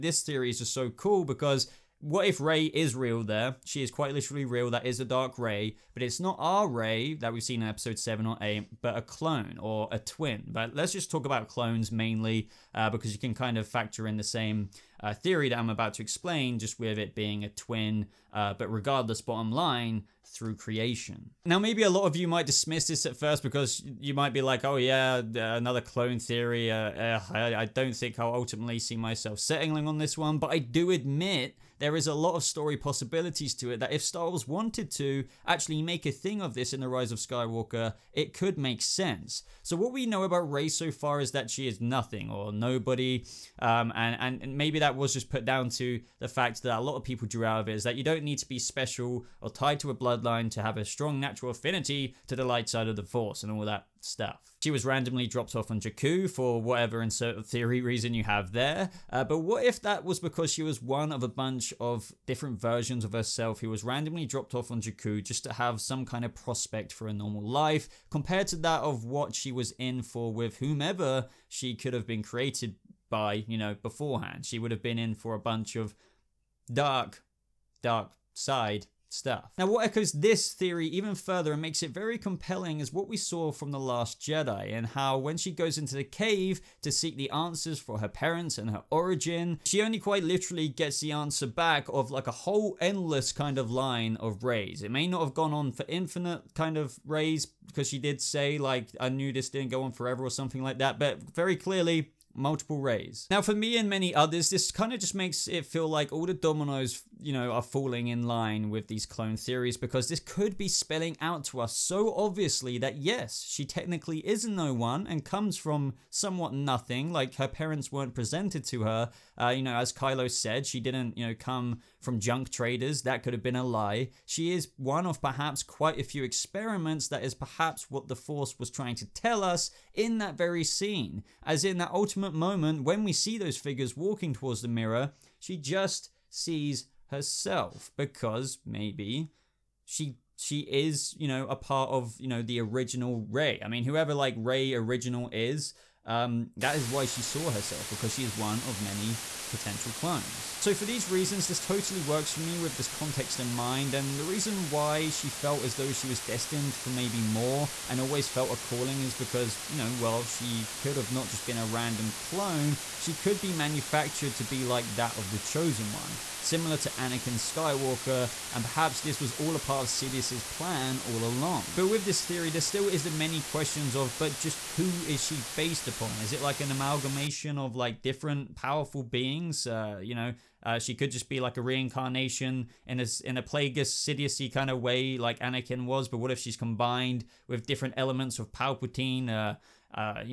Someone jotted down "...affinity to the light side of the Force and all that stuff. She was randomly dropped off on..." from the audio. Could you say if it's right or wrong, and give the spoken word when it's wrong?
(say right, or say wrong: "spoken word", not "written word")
right.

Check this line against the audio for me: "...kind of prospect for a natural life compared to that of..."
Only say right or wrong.
wrong.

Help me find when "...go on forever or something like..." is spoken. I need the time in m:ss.
1:39.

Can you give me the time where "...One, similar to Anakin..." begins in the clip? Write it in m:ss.
2:45.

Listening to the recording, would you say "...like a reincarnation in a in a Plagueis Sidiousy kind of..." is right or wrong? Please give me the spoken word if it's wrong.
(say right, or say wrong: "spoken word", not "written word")
right.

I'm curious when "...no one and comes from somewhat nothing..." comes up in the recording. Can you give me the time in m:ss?
1:54.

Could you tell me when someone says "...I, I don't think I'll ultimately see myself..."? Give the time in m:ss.
0:27.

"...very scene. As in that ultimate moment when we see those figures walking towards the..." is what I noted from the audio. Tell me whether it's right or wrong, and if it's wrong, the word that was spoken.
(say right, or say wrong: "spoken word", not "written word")
right.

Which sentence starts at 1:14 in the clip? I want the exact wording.
She would have been in for a bunch of dark, dark side stuff.